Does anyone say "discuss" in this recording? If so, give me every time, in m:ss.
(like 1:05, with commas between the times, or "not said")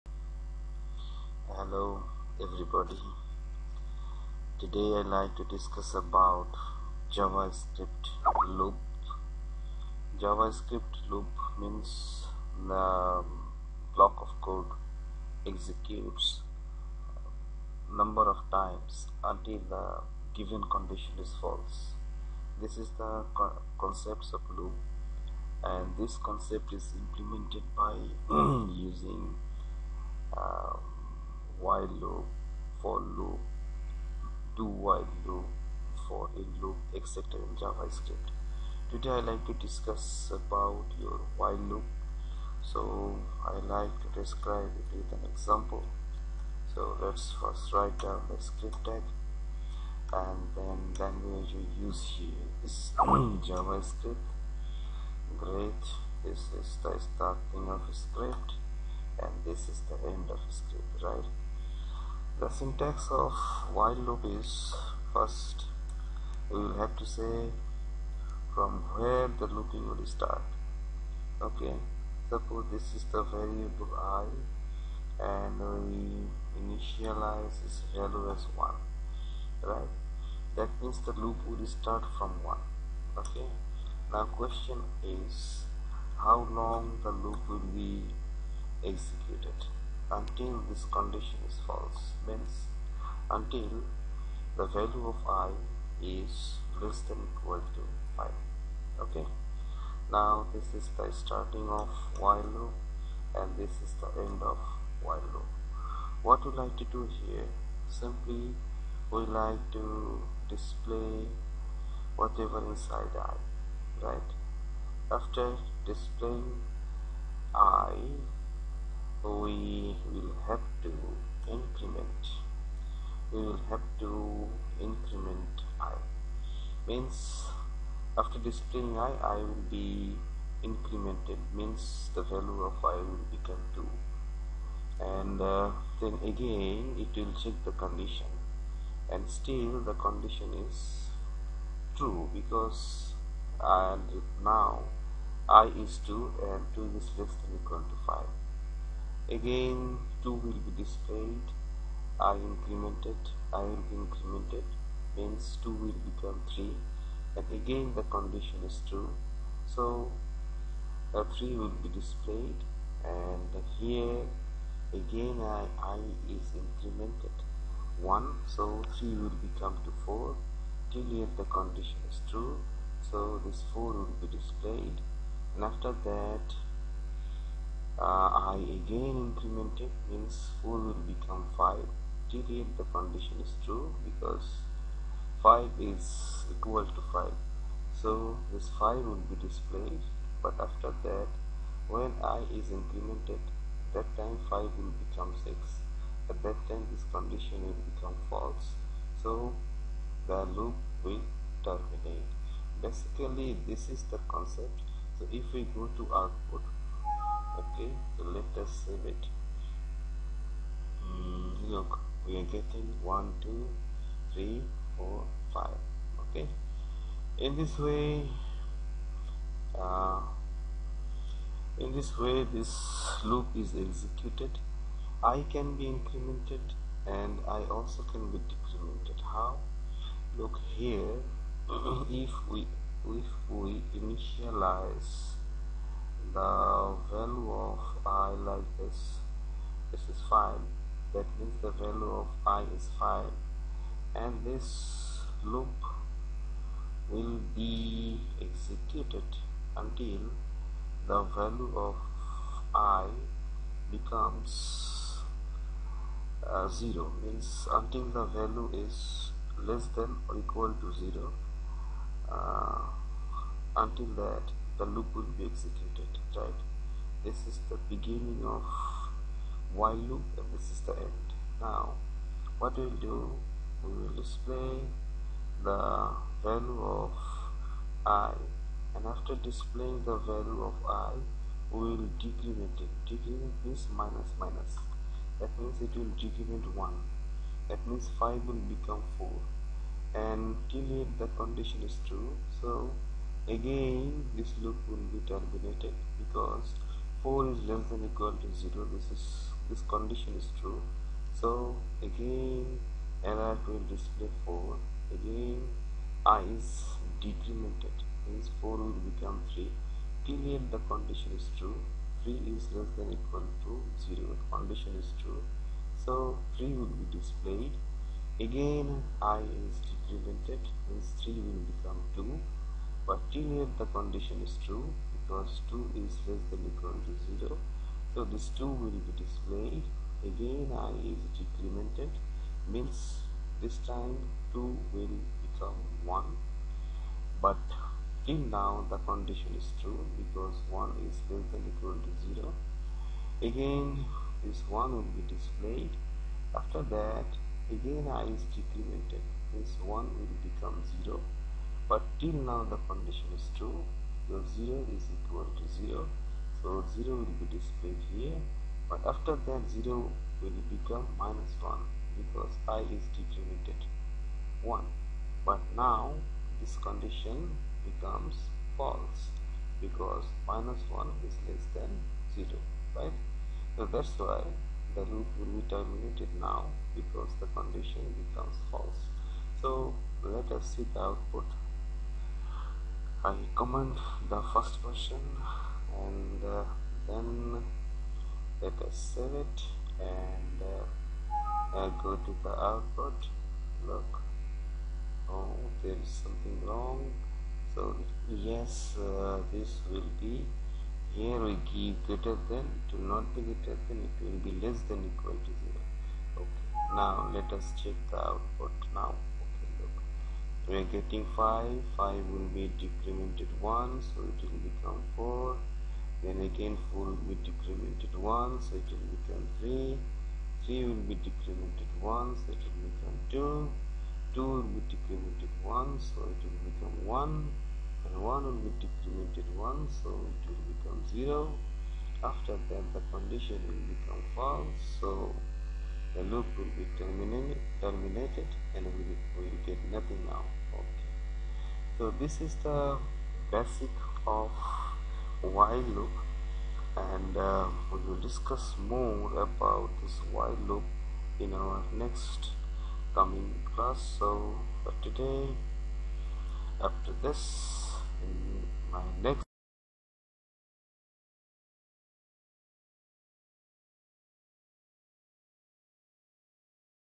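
0:05, 0:39, 7:28.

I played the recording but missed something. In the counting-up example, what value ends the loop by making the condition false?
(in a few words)
6.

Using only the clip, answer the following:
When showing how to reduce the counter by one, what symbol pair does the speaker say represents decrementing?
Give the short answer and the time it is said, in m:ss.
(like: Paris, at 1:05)
minus minus, at 4:44.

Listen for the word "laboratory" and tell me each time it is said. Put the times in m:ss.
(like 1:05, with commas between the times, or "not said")
not said.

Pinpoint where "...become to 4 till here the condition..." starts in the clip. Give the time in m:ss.
2:49.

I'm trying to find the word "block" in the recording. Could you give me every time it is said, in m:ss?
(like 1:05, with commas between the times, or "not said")
0:13.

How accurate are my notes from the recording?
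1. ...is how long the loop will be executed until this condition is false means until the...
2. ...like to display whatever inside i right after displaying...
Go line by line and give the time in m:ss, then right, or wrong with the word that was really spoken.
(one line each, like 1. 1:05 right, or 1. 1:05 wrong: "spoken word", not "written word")
1. 1:25 right
2. 1:49 right.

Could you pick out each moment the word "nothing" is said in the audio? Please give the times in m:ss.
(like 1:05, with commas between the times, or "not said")
7:19.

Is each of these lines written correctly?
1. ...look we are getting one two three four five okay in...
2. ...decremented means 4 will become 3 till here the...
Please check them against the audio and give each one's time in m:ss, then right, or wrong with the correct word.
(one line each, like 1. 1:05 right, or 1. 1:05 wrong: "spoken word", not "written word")
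1. 3:31 right
2. 5:07 right.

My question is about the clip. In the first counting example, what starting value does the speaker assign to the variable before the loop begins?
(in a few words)
1.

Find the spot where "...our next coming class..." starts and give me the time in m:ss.
7:31.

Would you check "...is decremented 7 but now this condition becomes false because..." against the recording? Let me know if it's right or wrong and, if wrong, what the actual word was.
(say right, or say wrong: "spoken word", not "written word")
wrong: "1", not "7".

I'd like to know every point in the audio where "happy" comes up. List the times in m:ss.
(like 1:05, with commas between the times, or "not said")
not said.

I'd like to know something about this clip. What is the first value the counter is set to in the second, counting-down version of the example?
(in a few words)
5.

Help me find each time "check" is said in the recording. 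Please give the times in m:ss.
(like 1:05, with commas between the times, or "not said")
2:17, 6:47.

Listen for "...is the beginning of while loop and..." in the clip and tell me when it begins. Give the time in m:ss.
4:27.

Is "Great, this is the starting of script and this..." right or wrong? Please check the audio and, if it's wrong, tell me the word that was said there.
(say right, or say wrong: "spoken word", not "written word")
right.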